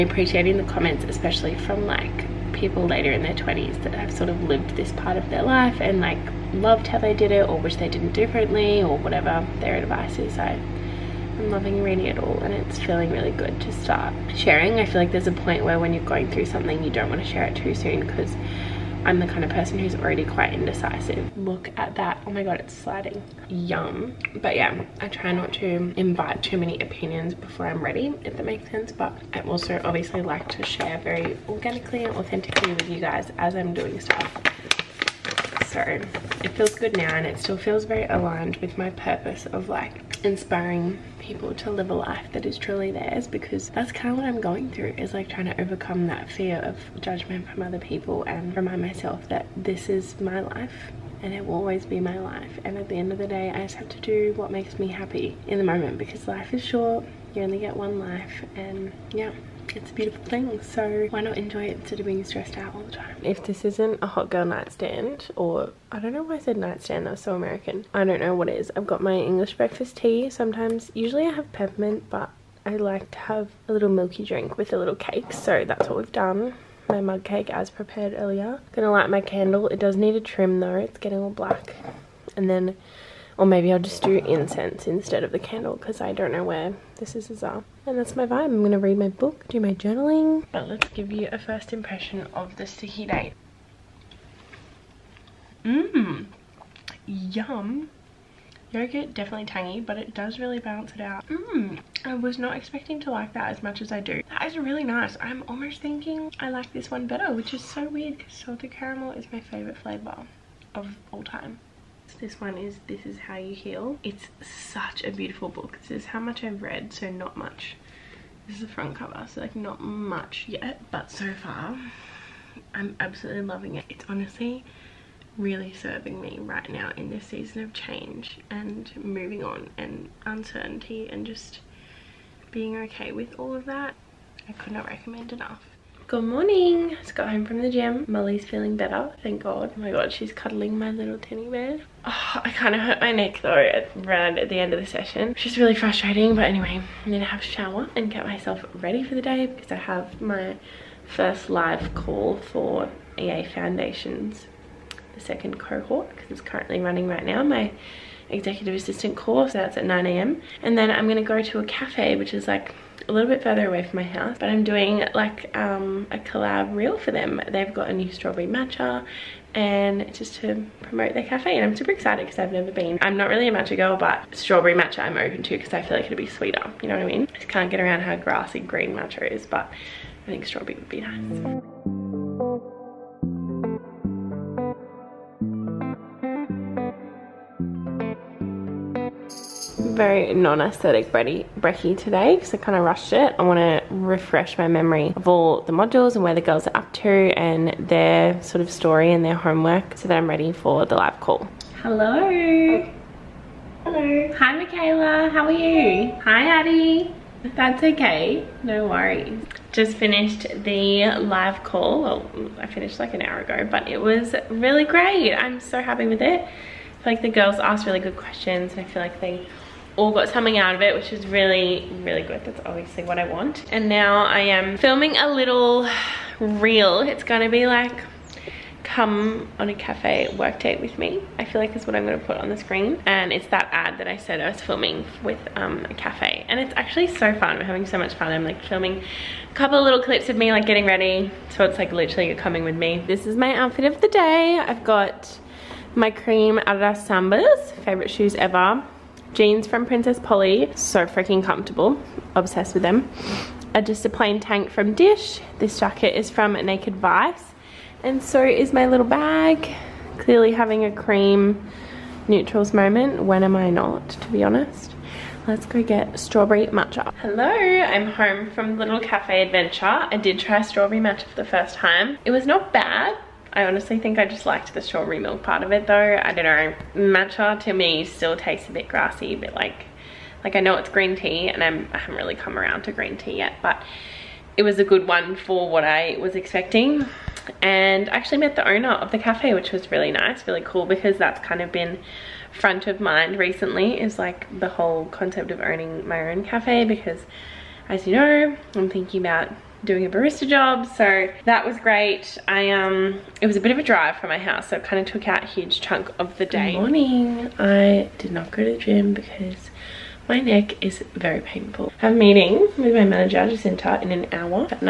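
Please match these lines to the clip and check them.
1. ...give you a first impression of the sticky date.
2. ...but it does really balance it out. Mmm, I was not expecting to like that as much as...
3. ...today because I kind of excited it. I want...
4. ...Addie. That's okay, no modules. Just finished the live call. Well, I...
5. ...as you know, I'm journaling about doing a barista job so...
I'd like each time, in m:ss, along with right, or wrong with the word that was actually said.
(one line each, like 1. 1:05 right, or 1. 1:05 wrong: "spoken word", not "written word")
1. 1:30 right
2. 1:39 right
3. 3:11 wrong: "rushed", not "excited"
4. 3:26 wrong: "worries", not "modules"
5. 4:57 wrong: "thinking", not "journaling".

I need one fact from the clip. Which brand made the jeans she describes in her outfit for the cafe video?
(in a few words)
Princess Polly.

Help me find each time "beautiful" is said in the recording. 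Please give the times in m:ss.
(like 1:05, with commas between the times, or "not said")
0:59, 1:55.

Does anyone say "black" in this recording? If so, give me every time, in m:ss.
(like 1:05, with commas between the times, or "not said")
1:21.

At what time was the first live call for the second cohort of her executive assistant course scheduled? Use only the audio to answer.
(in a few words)
9am.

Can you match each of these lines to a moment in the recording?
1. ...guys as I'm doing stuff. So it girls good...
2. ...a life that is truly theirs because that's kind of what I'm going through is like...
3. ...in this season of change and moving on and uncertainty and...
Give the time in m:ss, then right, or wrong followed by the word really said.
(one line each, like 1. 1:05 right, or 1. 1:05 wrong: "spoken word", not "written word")
1. 0:32 wrong: "feels", not "girls"
2. 0:41 right
3. 2:06 right.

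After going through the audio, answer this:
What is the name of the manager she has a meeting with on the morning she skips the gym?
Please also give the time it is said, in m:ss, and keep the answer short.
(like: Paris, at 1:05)
Jacinta, at 5:13.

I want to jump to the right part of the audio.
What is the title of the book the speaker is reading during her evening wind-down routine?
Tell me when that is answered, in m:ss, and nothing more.
1:52.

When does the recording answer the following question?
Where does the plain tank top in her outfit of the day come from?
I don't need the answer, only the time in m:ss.
4:14.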